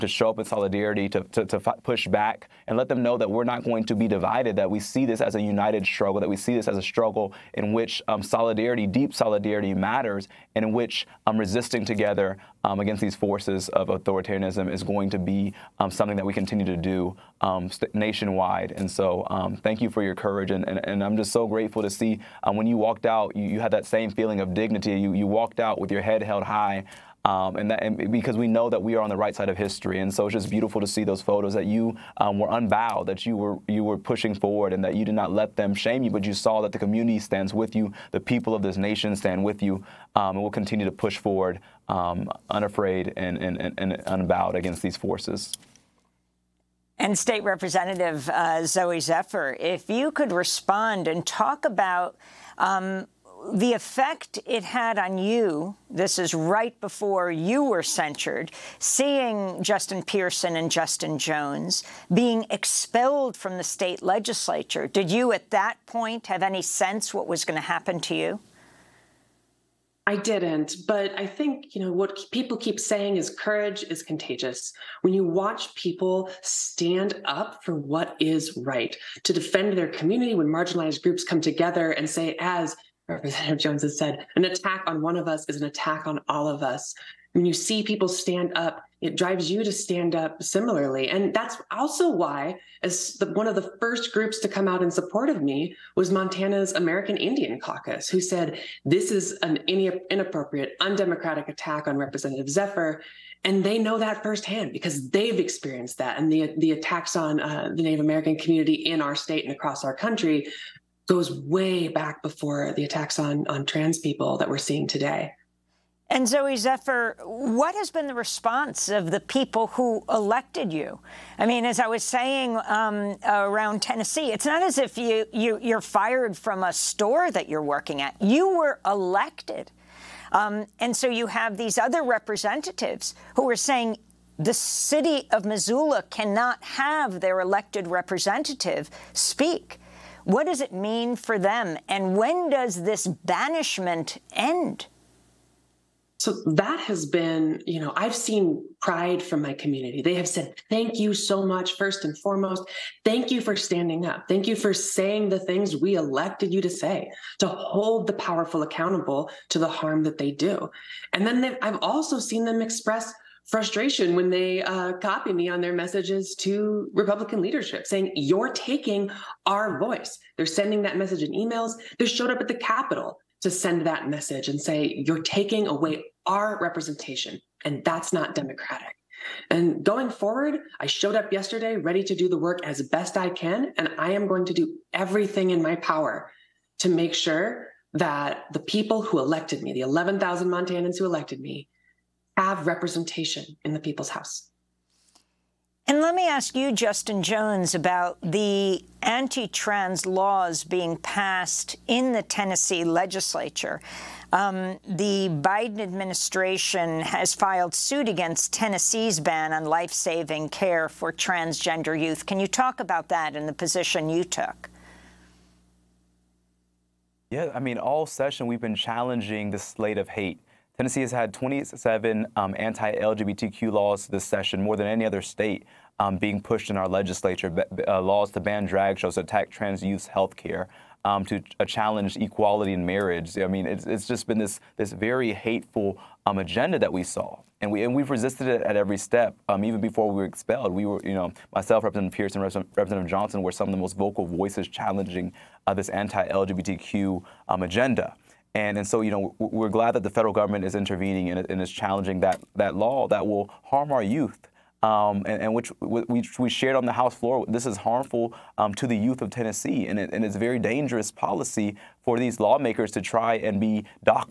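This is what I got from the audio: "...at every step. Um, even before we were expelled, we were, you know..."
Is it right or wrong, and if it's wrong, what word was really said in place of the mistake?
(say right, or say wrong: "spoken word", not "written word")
right.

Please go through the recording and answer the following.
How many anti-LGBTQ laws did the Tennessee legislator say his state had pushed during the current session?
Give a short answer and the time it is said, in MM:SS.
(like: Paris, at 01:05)
27, at 03:41.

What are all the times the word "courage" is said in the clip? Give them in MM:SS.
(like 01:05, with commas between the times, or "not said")
00:20, 01:13.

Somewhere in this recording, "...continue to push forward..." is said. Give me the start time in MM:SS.
00:40.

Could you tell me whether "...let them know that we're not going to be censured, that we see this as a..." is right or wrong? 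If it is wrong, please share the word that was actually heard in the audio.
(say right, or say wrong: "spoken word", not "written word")
wrong: "divided", not "censured".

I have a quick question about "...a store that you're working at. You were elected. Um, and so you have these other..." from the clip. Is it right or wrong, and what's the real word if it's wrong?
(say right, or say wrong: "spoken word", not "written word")
right.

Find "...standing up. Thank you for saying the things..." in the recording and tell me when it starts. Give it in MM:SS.
02:33.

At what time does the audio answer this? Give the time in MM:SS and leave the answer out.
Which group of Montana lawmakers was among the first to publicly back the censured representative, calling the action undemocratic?
01:36.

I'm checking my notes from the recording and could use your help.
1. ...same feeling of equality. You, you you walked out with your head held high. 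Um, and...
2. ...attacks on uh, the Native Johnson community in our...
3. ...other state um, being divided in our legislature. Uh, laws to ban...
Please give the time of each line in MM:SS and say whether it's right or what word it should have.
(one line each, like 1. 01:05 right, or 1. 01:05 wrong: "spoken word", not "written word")
1. 00:23 wrong: "dignity", not "equality"
2. 01:46 wrong: "American", not "Johnson"
3. 03:45 wrong: "pushed", not "divided".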